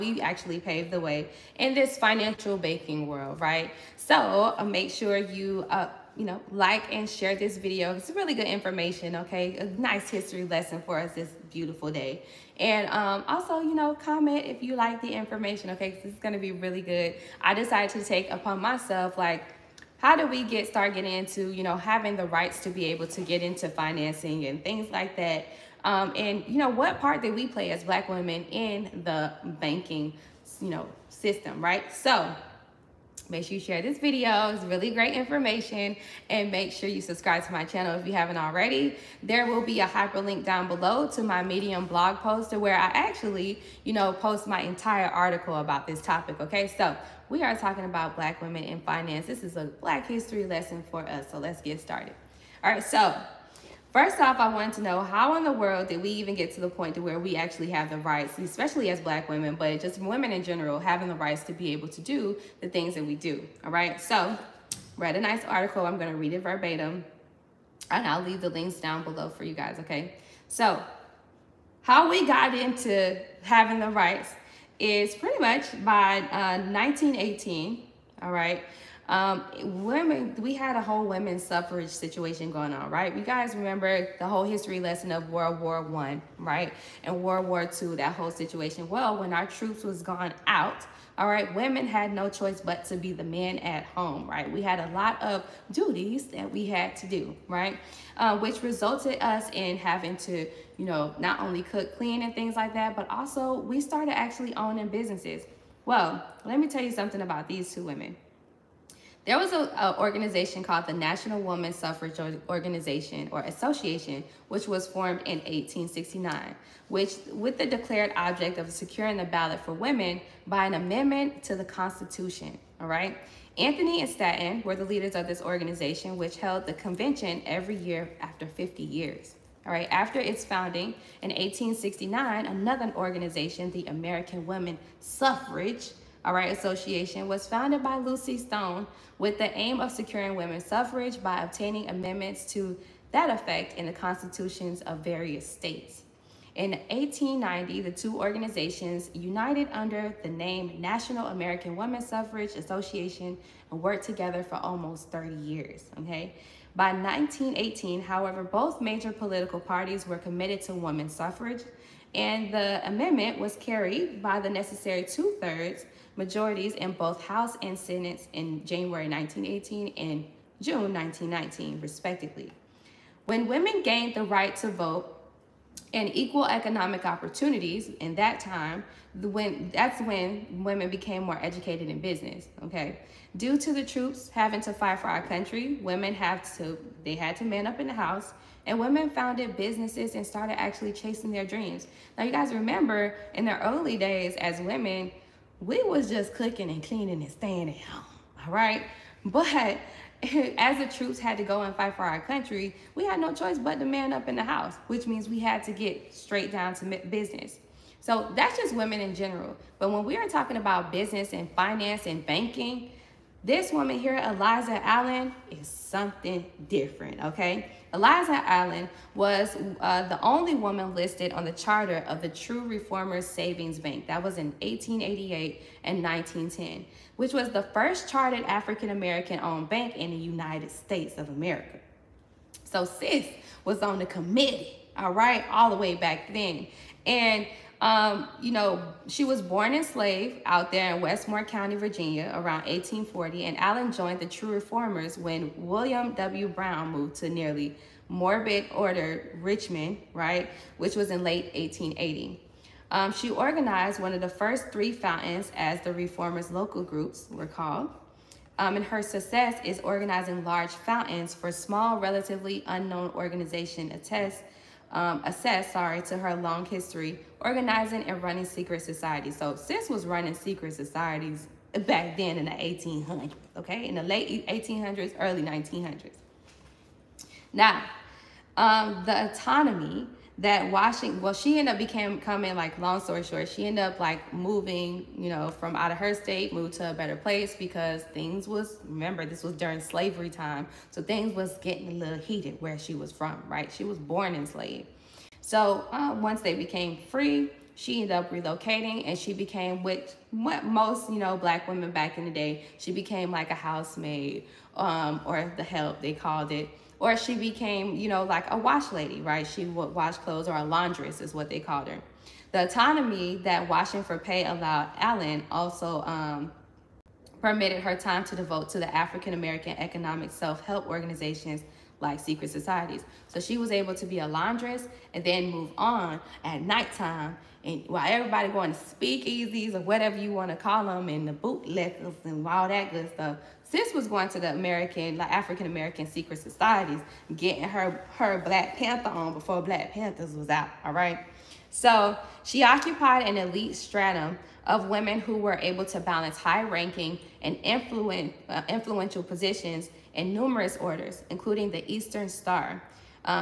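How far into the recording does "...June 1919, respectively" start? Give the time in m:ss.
2:50.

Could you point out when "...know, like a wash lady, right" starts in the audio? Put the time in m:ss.
5:08.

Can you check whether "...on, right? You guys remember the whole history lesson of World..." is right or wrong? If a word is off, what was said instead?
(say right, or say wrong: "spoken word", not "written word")
right.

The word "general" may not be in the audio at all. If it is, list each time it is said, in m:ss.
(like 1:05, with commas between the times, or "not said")
1:00, 3:29.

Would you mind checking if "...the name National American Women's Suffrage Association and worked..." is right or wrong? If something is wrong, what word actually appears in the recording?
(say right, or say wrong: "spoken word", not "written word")
right.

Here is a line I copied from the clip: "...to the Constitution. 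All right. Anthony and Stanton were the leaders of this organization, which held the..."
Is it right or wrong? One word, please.
right.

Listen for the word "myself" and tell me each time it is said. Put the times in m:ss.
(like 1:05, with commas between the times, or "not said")
0:18.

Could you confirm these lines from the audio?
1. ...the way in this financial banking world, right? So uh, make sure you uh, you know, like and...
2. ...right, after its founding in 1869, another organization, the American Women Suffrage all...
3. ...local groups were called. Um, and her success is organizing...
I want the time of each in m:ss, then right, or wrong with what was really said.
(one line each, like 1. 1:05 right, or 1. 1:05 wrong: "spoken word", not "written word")
1. 0:00 right
2. 2:09 right
3. 4:16 right.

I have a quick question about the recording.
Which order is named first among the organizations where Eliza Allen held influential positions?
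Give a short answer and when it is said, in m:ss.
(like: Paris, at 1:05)
Eastern Star, at 5:51.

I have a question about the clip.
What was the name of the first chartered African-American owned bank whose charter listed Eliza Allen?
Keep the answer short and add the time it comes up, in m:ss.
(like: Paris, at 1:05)
True Reformers Savings Bank, at 3:42.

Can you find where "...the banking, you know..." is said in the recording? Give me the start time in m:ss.
0:29.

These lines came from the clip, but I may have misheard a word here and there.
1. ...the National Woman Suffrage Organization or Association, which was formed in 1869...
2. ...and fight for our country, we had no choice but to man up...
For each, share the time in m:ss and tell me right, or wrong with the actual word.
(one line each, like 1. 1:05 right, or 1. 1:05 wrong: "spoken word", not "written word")
1. 1:50 right
2. 3:21 right.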